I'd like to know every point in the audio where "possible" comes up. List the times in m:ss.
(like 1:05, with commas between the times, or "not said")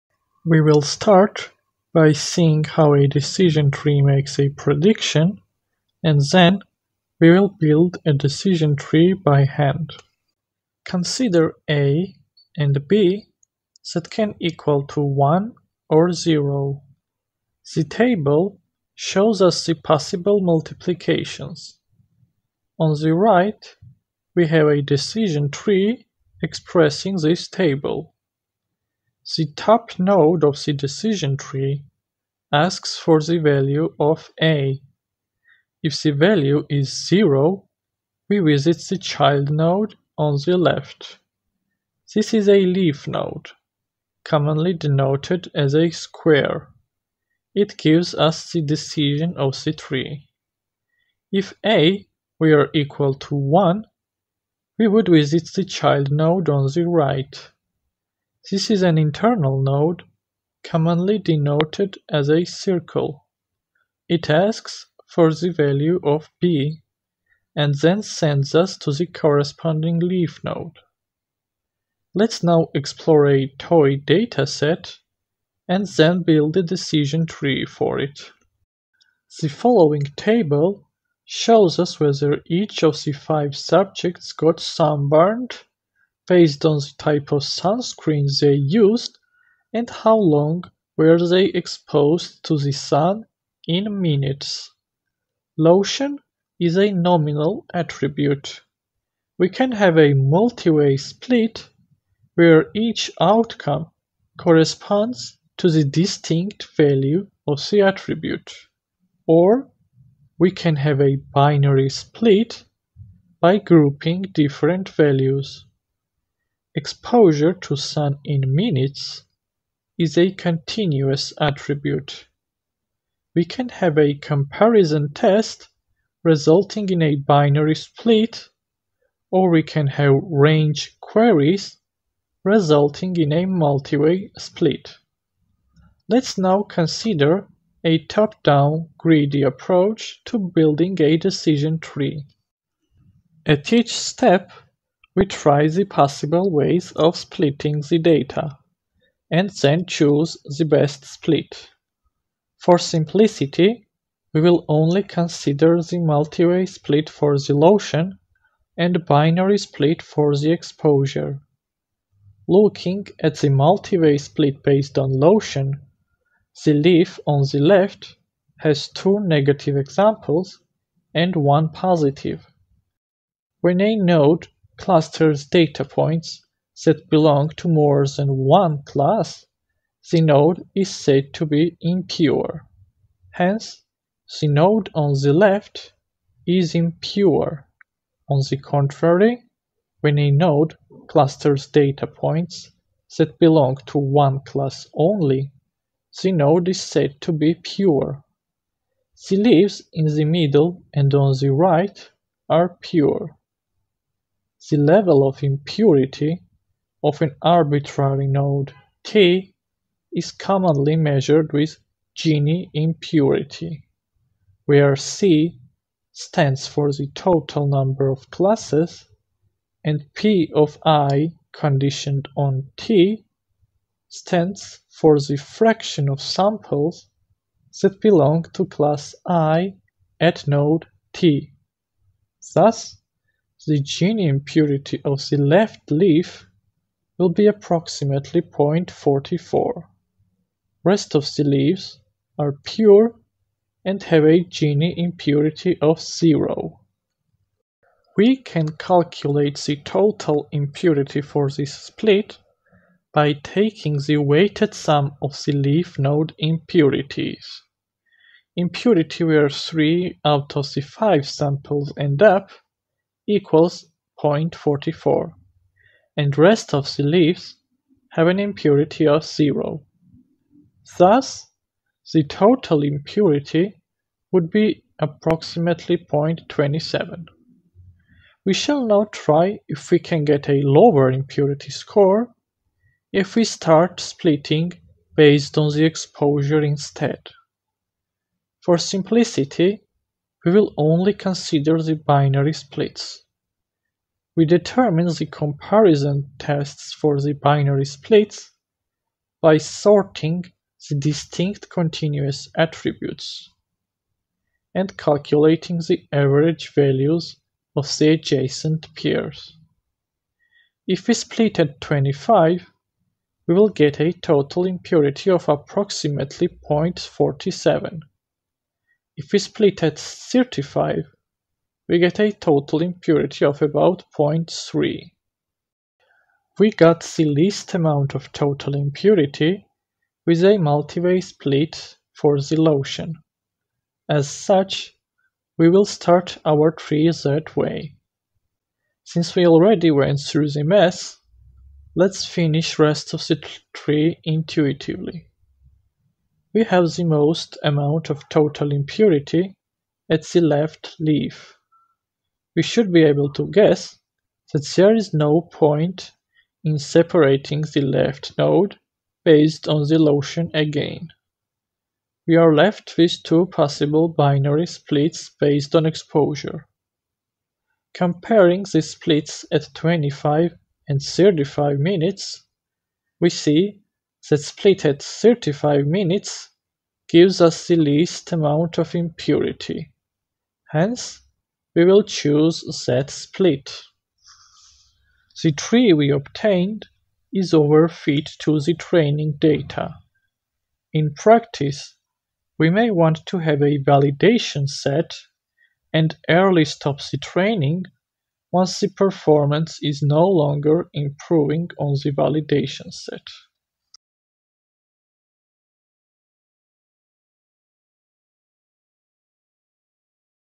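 0:19, 2:25, 6:03.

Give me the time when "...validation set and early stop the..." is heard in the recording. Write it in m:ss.
6:33.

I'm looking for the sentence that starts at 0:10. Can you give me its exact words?
Consider A and B that can equal to 1 or 0.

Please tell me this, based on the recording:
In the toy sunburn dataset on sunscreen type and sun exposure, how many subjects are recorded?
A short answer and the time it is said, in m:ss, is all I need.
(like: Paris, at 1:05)
5, at 1:23.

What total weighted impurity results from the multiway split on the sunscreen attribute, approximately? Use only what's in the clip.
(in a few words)
0.27.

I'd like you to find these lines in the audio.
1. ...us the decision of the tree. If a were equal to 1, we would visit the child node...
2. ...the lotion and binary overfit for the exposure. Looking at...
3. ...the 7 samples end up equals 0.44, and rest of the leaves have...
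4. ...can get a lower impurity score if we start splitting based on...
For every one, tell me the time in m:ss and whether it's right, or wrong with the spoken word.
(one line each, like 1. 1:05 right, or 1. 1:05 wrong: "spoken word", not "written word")
1. 0:48 right
2. 2:37 wrong: "split", not "overfit"
3. 4:20 wrong: "5", not "7"
4. 4:39 right.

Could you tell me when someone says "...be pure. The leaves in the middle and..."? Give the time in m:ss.
3:17.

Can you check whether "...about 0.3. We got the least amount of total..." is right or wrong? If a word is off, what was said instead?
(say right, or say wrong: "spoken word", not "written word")
right.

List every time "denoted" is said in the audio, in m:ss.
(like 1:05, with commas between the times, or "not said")
0:44, 1:01.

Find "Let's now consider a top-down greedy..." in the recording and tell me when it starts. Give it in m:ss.
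2:16.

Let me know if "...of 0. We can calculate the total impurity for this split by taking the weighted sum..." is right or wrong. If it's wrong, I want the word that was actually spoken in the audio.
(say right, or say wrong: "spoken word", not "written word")
right.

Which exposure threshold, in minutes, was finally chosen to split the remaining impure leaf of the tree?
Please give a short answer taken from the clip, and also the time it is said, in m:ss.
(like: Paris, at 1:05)
35 minutes, at 6:15.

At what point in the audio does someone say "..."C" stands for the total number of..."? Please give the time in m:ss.
3:34.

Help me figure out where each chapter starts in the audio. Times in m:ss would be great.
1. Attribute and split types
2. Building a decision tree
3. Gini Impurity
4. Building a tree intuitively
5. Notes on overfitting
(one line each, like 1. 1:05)
1. 1:18
2. 2:22
3. 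2:45
4. 5:26
5. 6:24.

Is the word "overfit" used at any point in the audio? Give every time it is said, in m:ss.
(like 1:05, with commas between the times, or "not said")
6:27.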